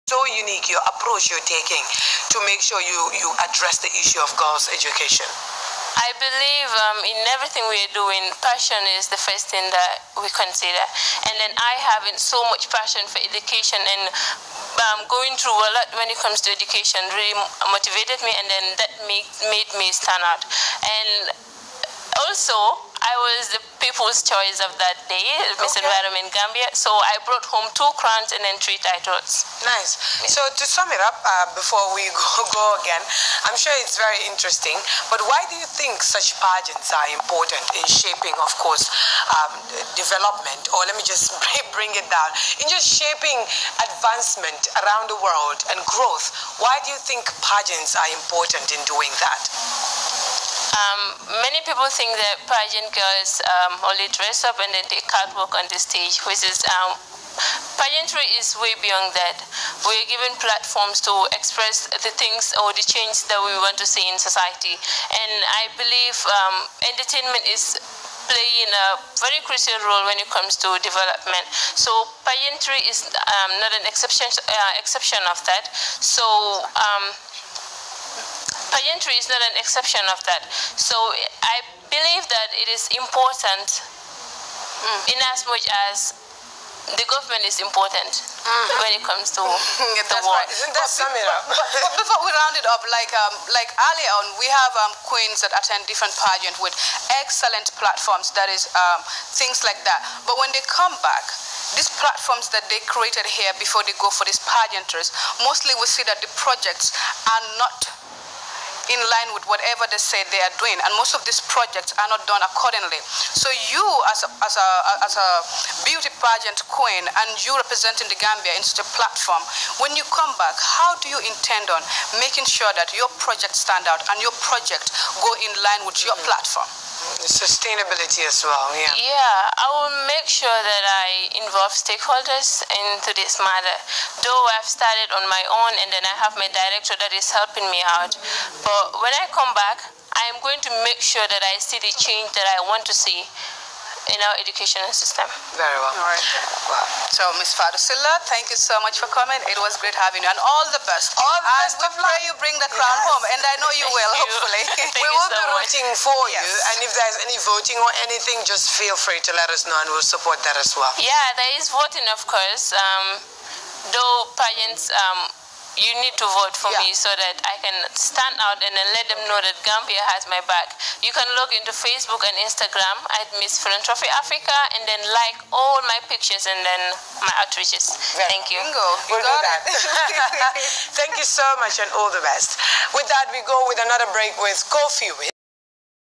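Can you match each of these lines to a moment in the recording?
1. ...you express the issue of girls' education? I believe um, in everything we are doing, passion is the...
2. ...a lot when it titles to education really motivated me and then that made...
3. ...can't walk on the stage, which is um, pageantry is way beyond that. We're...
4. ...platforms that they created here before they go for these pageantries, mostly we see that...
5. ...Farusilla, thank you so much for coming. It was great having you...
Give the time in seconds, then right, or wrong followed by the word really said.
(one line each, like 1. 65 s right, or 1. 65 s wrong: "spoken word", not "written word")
1. 3 s wrong: "address", not "express"
2. 15 s wrong: "comes", not "titles"
3. 55 s right
4. 102 s right
5. 147 s right.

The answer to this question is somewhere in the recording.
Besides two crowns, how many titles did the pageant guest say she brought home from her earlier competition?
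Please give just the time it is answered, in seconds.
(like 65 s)
28 s.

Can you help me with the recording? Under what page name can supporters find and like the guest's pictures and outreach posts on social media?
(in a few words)
Miss Philanthropy Africa.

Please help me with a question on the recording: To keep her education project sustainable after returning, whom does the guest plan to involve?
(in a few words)
Stakeholders.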